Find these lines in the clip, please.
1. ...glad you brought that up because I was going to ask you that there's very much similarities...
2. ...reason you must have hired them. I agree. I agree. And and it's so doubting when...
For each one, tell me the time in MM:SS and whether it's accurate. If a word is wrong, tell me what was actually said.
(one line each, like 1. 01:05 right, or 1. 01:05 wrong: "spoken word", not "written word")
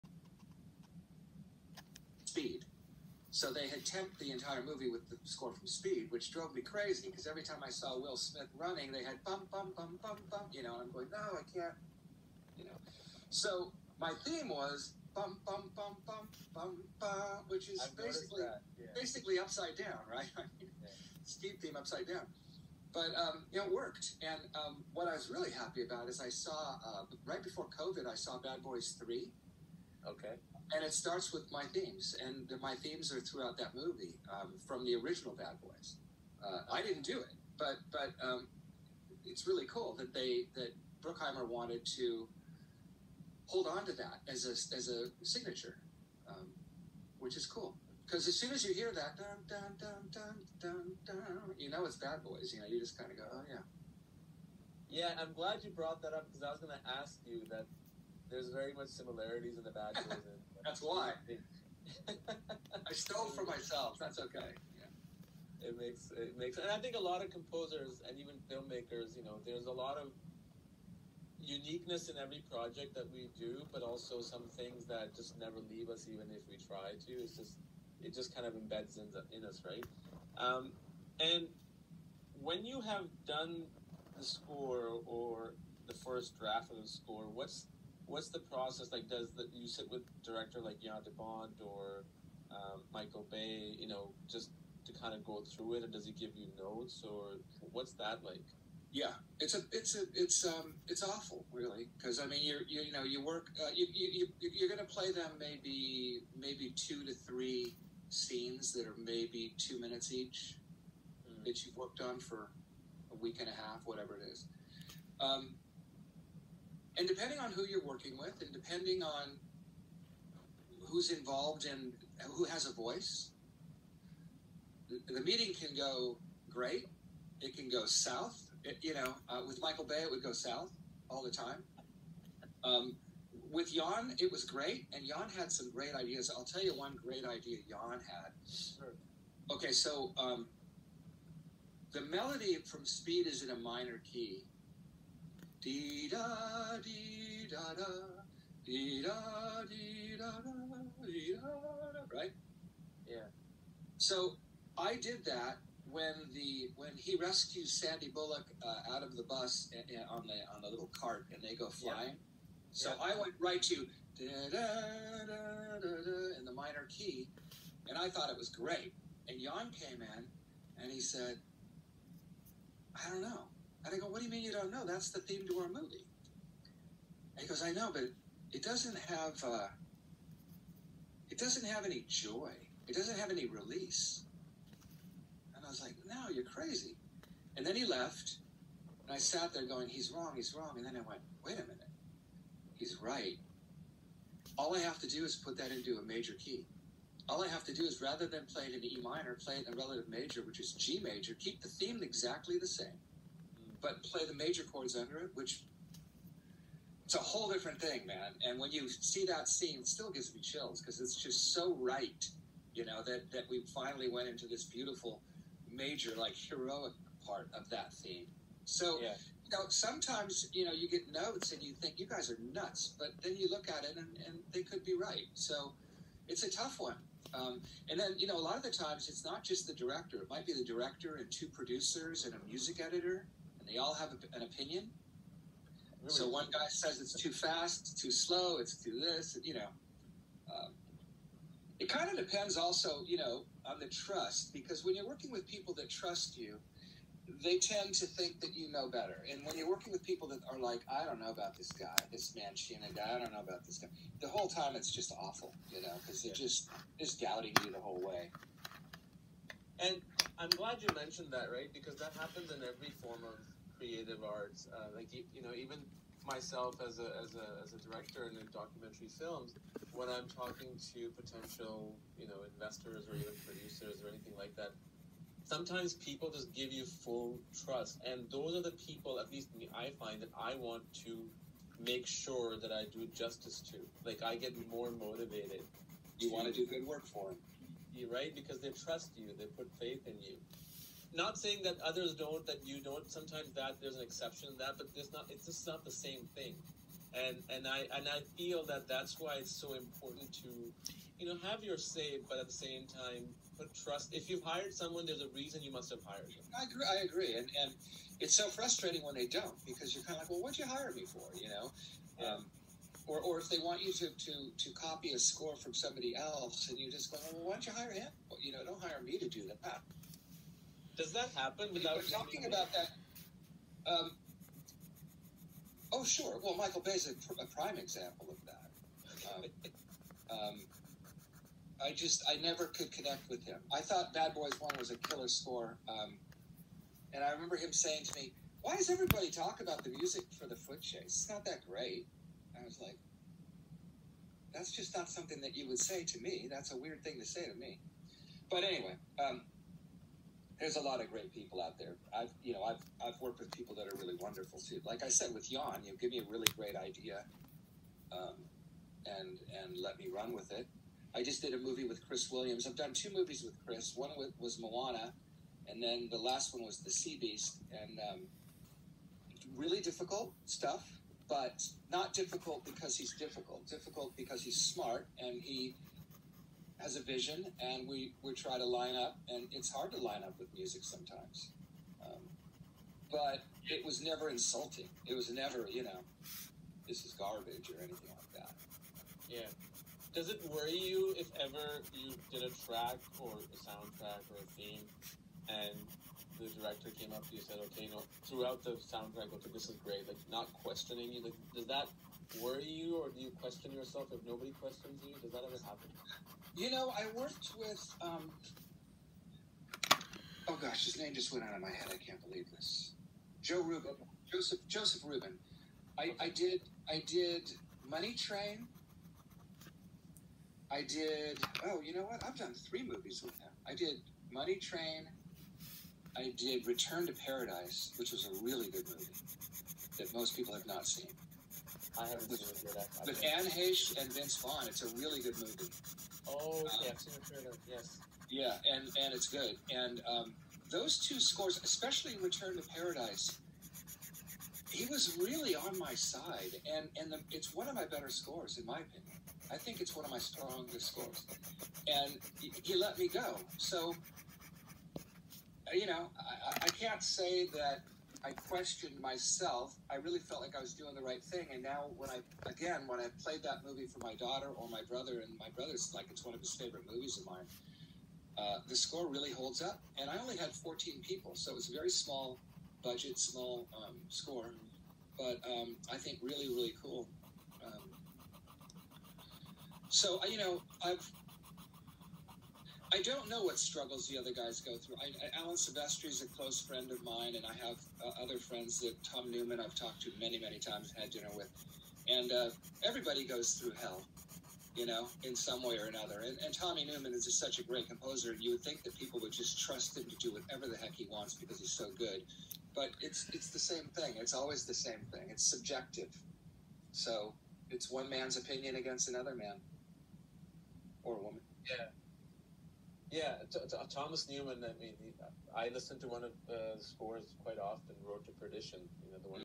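1. 00:55 right
2. 05:05 wrong: "frustrating", not "doubting".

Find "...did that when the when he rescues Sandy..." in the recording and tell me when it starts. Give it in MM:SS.
02:34.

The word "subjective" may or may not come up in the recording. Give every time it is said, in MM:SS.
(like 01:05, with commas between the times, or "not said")
08:25.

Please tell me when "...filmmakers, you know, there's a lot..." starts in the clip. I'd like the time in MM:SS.
01:08.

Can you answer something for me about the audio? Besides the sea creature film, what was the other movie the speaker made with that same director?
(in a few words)
Moana.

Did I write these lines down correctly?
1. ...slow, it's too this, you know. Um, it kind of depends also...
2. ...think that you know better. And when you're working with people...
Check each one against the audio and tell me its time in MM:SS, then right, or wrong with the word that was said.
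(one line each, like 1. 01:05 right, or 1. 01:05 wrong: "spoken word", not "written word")
1. 03:58 right
2. 04:08 right.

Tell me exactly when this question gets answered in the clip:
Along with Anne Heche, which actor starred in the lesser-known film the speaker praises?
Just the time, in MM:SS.
07:14.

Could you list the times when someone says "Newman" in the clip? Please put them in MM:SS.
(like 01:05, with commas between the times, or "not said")
08:09, 08:16, 08:34.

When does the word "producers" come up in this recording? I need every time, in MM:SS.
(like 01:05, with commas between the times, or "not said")
03:51, 04:33.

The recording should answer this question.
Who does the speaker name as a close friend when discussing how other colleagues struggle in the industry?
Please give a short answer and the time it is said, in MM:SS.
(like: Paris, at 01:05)
Alan Silvestri, at 08:05.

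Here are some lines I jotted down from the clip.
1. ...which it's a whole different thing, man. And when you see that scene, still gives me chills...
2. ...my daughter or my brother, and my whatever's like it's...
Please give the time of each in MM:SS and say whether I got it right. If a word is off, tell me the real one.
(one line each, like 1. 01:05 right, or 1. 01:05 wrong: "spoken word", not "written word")
1. 03:25 right
2. 07:44 wrong: "brother", not "whatever".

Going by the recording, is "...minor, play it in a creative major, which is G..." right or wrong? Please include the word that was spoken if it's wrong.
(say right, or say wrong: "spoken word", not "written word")
wrong: "relative", not "creative".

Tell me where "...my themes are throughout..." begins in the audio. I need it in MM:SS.
00:32.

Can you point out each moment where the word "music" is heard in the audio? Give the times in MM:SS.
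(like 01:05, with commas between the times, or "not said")
03:52, 05:39, 06:20.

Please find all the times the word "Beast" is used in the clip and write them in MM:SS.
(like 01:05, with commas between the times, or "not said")
06:07.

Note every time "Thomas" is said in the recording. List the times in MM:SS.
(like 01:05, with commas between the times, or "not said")
08:33.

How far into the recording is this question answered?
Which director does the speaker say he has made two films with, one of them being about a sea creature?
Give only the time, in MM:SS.
06:02.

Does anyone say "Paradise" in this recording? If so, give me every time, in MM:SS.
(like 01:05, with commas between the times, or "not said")
07:07, 07:22.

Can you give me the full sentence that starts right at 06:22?
Um, but it was never insulting.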